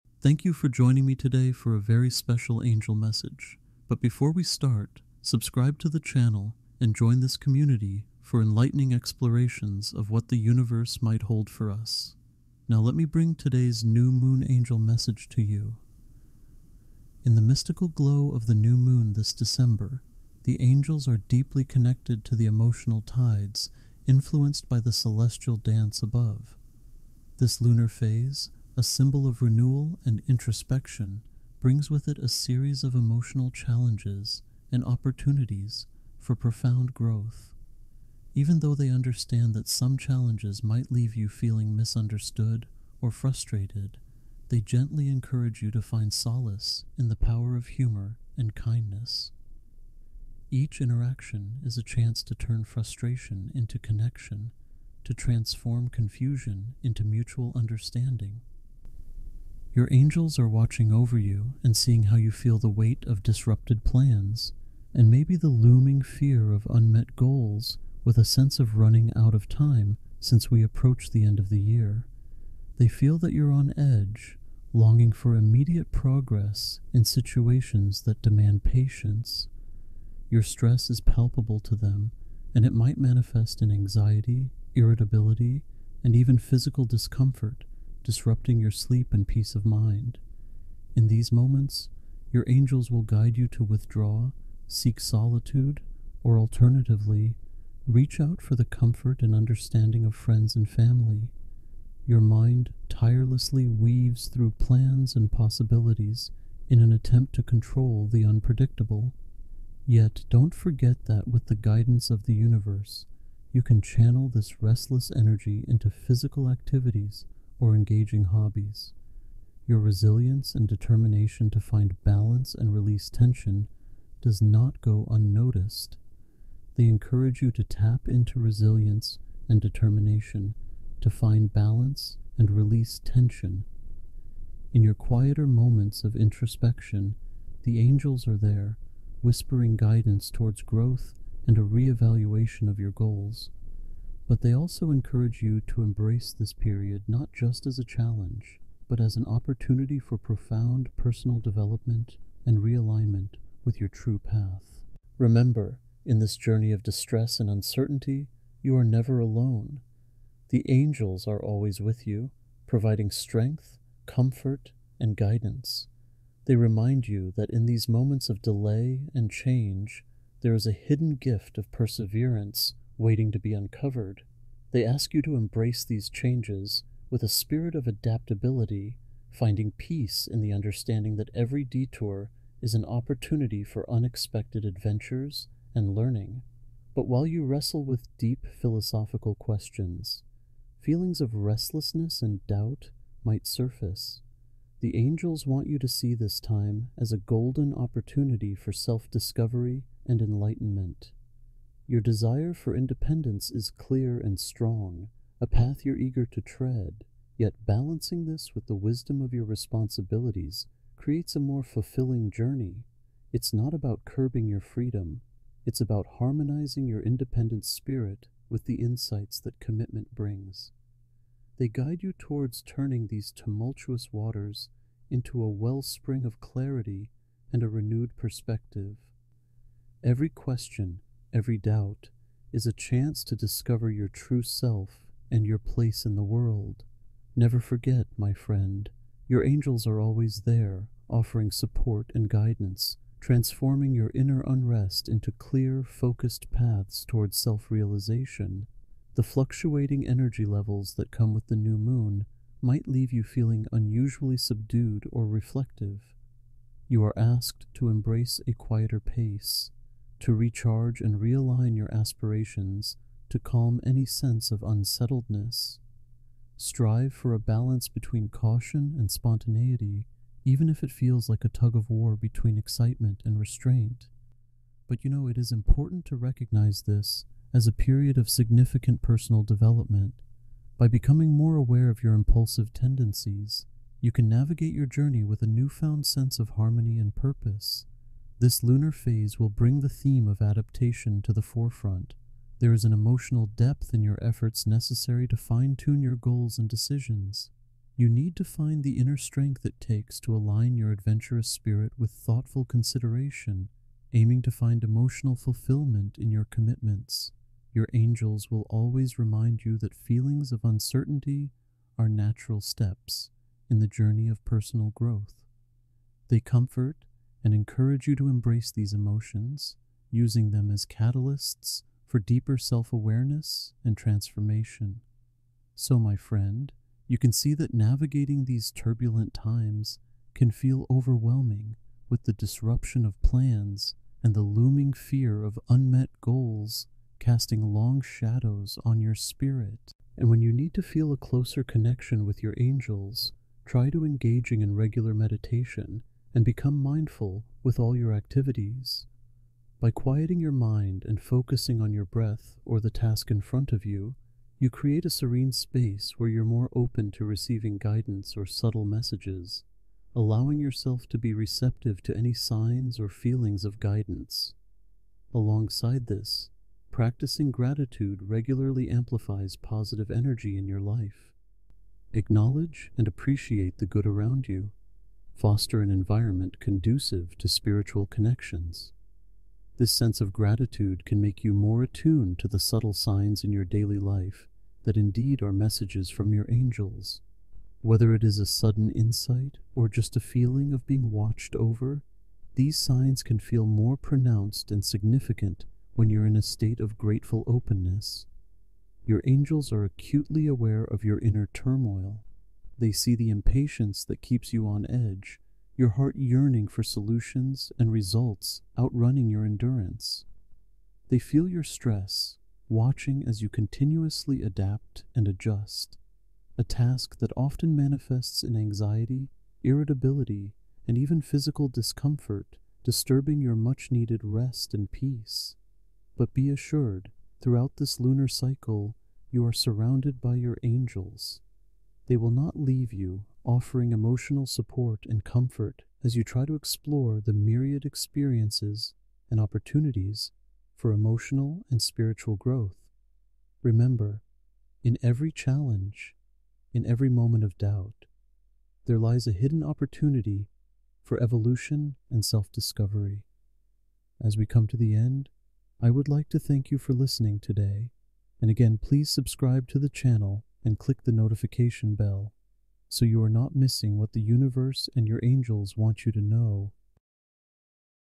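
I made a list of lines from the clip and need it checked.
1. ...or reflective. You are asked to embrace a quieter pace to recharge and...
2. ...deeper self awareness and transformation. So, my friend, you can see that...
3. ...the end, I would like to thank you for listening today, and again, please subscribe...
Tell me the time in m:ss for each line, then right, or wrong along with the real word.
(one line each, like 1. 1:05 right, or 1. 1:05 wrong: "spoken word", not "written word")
1. 4:15 right
2. 5:22 right
3. 7:34 right.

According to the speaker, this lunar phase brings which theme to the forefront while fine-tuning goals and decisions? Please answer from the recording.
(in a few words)
adaptation.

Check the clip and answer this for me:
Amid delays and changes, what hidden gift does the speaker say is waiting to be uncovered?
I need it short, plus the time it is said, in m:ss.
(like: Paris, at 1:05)
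perseverance, at 2:51.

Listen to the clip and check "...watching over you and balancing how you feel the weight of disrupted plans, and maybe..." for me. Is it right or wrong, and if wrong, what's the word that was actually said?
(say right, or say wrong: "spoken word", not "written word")
wrong: "seeing", not "balancing".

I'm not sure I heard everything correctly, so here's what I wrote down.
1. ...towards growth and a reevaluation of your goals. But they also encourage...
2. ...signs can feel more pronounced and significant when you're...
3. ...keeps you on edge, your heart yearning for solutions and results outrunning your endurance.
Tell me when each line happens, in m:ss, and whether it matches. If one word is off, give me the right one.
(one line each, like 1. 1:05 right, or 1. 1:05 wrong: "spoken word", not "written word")
1. 2:20 right
2. 6:32 right
3. 6:44 right.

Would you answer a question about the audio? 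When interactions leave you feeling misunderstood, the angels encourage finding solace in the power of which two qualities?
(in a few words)
humor and kindness.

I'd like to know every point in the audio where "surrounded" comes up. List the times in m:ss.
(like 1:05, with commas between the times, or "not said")
7:09.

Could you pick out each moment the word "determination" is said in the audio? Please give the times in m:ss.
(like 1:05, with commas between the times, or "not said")
2:00, 2:09.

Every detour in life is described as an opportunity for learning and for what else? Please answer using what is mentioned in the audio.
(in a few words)
unexpected adventures.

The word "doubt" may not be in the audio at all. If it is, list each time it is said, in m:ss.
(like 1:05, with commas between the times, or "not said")
3:12, 3:51, 7:27.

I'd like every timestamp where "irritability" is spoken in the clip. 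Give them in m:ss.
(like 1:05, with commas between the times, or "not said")
1:24, 6:59.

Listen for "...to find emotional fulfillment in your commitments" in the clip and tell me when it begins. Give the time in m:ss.
5:04.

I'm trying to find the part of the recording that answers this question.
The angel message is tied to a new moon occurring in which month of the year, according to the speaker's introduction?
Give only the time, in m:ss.
0:19.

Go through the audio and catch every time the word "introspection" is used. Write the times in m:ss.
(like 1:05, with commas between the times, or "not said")
0:30, 2:16.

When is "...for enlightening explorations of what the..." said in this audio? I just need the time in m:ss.
0:08.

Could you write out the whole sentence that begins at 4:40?
By becoming more aware of your impulsive tendencies, you can navigate your journey with a newfound sense of harmony and purpose.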